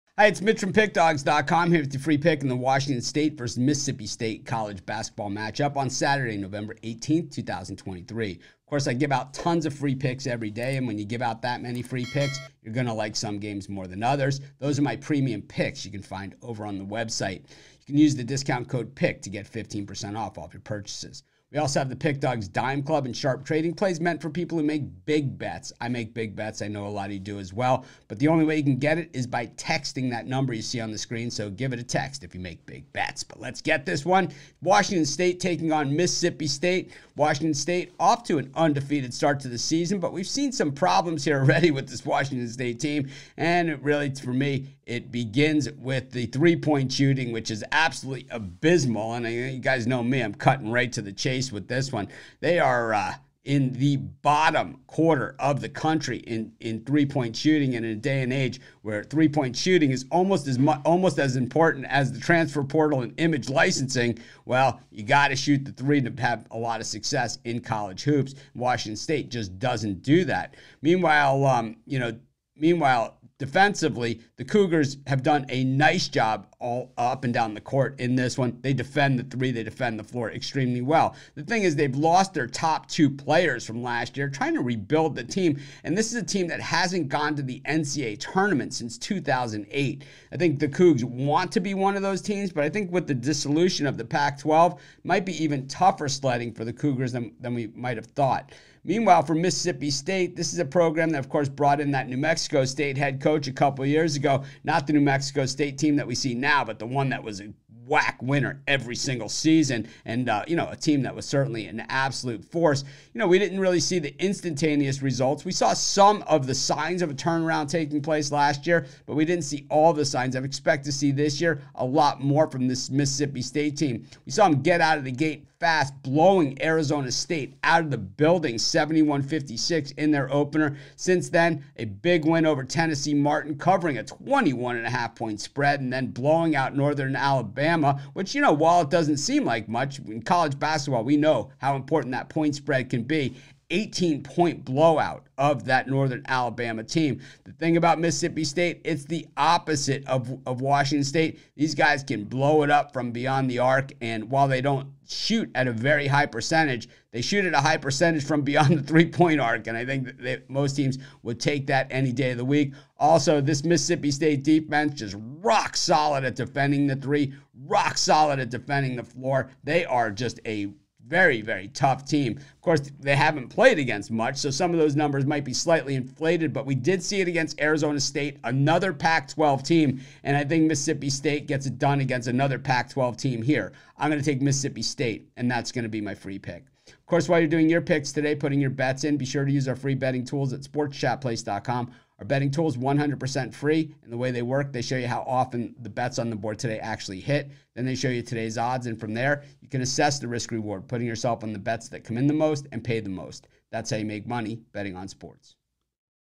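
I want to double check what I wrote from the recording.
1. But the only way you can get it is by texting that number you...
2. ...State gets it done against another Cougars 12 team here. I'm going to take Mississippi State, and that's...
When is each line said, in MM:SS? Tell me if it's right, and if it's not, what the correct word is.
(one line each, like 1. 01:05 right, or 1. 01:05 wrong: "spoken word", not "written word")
1. 00:28 right
2. 03:01 wrong: "Pac", not "Cougars".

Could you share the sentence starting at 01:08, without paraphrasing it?
Washington State just doesn't do that.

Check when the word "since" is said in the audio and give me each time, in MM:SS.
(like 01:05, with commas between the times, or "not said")
01:28, 02:10.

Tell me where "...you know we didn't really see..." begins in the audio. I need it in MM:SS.
01:53.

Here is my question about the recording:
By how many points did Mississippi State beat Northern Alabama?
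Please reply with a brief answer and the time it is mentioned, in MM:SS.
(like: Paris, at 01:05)
18, at 02:23.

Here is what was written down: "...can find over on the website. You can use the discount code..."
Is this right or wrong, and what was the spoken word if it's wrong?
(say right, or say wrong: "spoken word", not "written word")
right.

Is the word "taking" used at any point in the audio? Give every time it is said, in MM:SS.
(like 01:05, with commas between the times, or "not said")
00:35, 01:57.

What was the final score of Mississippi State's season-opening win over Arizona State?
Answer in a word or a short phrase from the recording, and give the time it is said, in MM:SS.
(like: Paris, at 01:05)
71-56, at 02:08.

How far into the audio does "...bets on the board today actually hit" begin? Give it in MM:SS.
03:15.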